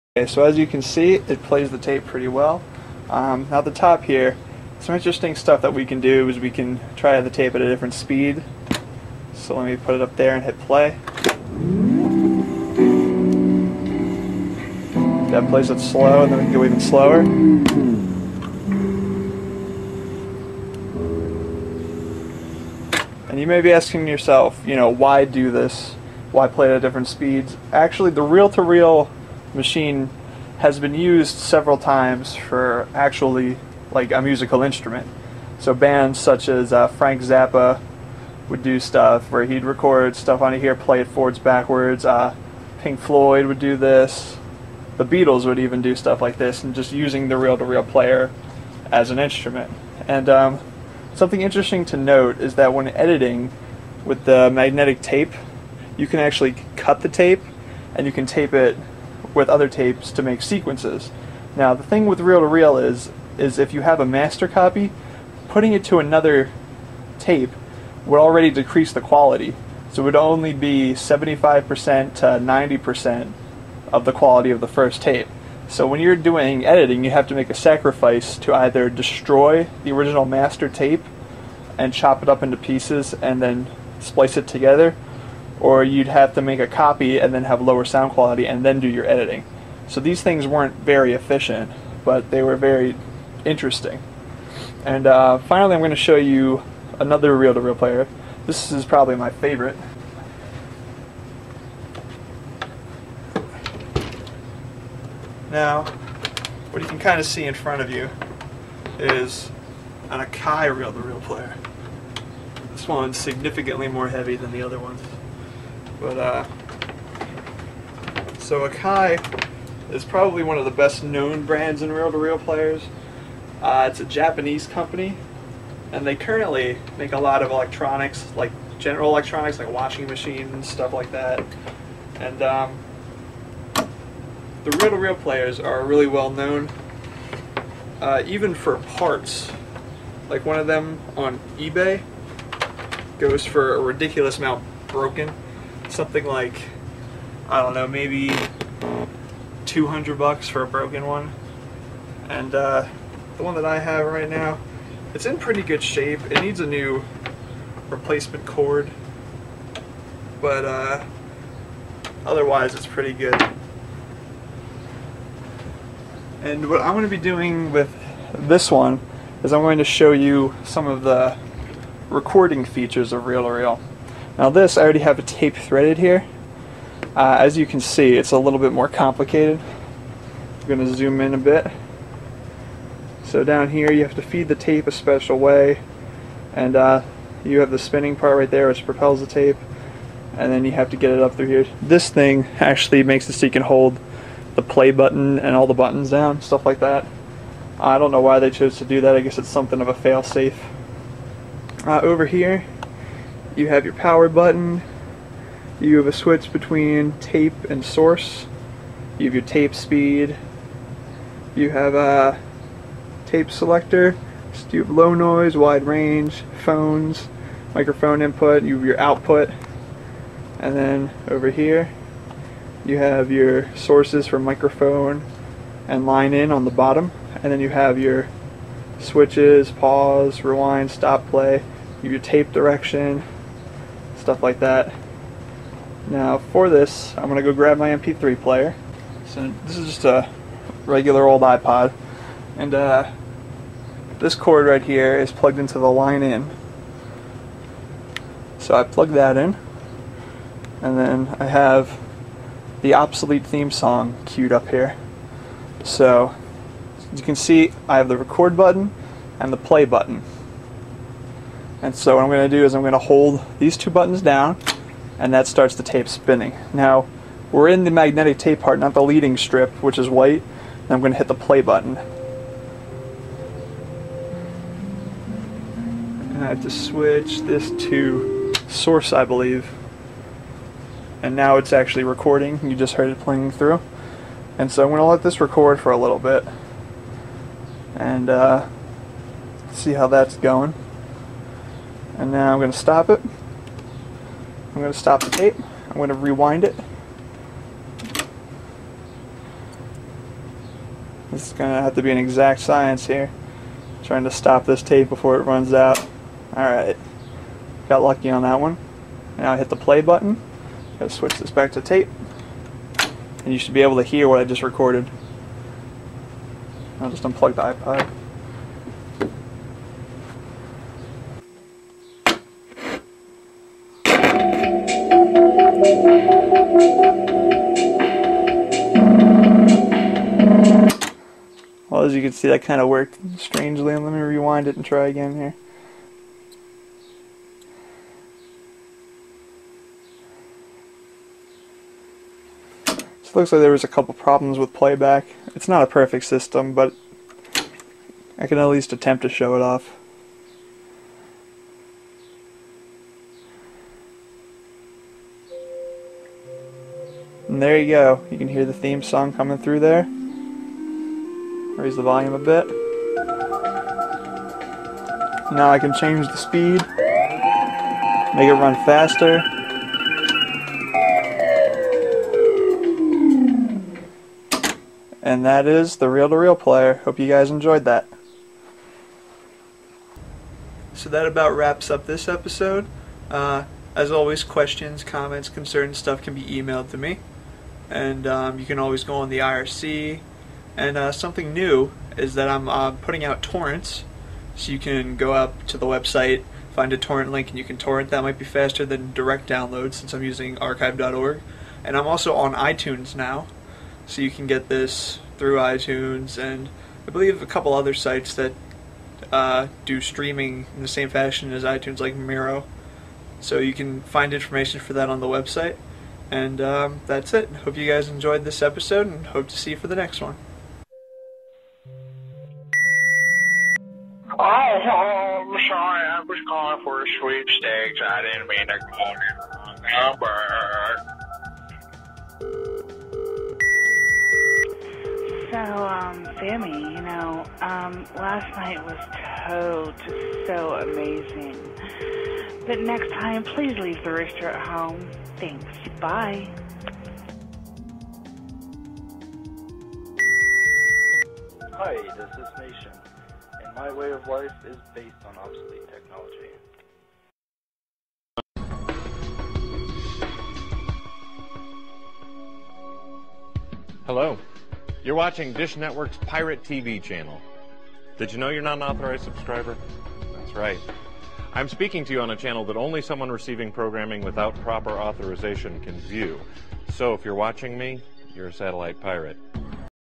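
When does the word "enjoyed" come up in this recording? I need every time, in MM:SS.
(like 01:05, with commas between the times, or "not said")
06:17, 06:58.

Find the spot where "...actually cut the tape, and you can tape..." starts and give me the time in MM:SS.
00:56.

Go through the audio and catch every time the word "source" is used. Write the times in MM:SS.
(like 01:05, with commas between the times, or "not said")
03:27, 03:43, 04:38.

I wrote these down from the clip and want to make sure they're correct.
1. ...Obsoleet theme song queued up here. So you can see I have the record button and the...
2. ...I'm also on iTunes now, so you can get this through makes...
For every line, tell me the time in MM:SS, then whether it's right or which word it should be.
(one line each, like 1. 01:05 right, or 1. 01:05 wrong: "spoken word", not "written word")
1. 04:12 right
2. 06:41 wrong: "iTunes", not "makes".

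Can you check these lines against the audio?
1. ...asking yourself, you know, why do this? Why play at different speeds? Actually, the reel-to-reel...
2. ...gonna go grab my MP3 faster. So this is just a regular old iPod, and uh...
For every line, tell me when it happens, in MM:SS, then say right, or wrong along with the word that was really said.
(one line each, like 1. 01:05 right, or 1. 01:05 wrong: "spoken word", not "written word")
1. 00:23 right
2. 03:57 wrong: "player", not "faster".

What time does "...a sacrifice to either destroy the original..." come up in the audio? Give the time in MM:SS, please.
01:17.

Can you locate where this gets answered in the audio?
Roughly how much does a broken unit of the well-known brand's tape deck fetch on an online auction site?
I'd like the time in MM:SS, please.
02:29.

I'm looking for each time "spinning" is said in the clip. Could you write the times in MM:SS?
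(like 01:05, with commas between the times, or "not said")
03:07, 04:26.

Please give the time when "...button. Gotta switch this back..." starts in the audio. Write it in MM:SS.
05:10.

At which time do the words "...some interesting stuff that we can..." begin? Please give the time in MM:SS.
00:04.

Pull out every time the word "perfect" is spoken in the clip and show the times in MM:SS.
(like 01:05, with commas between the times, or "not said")
05:45.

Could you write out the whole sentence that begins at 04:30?
And I'm going to hit the play button.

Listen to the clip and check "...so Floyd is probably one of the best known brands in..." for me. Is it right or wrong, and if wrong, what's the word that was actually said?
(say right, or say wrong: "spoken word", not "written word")
wrong: "Akai", not "Floyd".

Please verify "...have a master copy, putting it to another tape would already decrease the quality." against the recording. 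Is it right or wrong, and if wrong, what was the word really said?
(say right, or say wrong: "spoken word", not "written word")
right.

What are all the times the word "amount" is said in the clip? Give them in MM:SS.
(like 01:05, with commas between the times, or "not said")
02:24.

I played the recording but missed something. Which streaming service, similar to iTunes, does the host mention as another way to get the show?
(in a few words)
Miro.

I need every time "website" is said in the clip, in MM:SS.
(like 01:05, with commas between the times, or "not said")
06:35, 06:55.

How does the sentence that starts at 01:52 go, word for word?
This one's significantly more heavy than the other ones.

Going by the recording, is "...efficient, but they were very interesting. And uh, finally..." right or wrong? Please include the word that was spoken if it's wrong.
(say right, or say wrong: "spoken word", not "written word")
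right.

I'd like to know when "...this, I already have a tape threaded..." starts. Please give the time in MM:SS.
02:54.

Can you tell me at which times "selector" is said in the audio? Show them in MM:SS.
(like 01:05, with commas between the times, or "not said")
03:33.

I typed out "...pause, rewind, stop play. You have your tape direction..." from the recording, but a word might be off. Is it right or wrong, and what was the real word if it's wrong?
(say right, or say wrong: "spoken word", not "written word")
right.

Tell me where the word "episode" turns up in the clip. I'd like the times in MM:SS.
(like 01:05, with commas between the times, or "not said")
06:22, 06:58.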